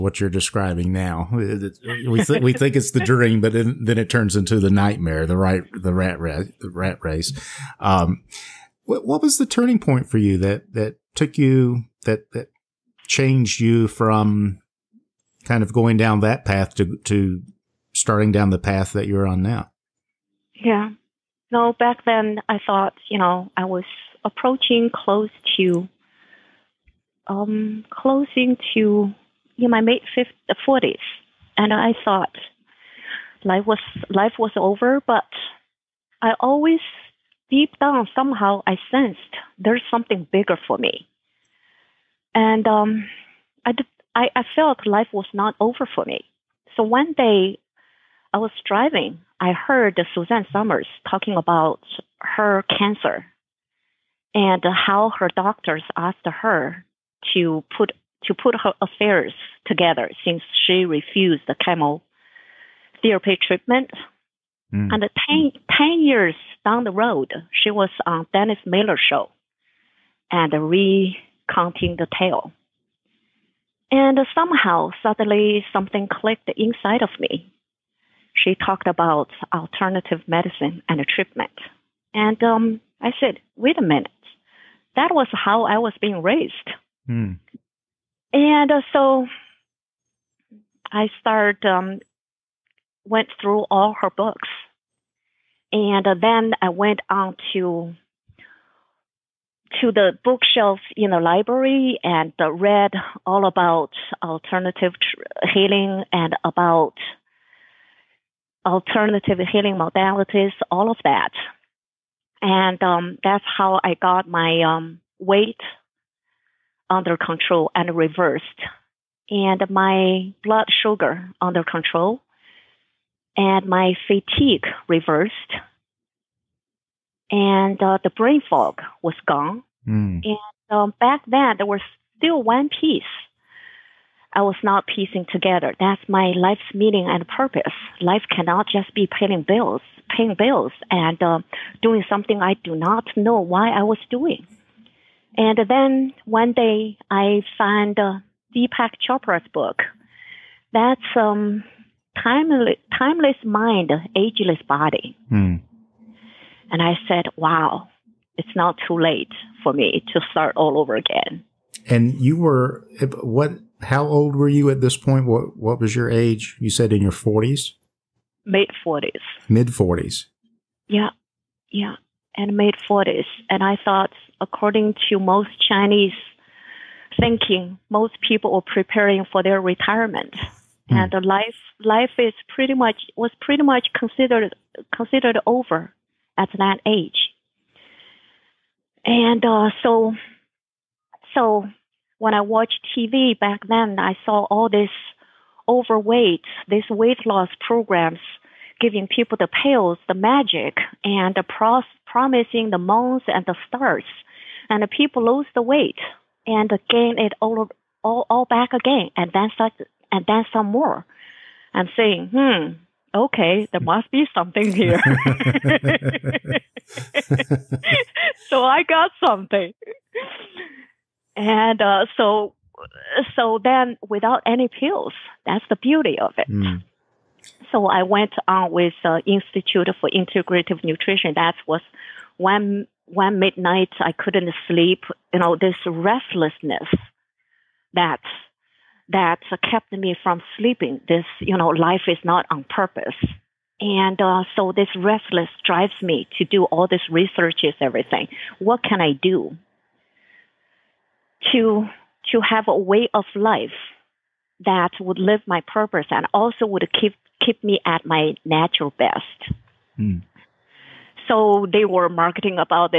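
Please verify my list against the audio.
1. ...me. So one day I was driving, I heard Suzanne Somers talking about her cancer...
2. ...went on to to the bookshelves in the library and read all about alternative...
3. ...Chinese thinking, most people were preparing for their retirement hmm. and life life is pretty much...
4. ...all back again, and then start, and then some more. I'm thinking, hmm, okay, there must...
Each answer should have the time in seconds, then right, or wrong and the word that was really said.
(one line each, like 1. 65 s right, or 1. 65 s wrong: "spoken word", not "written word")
1. 46 s right
2. 96 s right
3. 175 s right
4. 208 s wrong: "saying", not "thinking".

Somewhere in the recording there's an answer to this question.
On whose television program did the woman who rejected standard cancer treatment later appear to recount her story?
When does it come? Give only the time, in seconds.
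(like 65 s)
68 s.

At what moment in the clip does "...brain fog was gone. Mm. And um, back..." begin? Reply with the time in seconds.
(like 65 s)
128 s.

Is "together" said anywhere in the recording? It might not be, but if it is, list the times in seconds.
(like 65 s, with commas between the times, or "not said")
59 s, 135 s.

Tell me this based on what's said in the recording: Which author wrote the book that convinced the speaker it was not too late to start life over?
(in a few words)
Deepak Chopra.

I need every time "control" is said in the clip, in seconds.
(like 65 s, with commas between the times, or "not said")
117 s, 121 s.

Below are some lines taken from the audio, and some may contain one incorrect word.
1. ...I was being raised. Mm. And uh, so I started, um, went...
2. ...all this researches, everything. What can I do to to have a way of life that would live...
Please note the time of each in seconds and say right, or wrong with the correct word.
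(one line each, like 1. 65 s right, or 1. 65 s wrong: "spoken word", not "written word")
1. 85 s right
2. 246 s right.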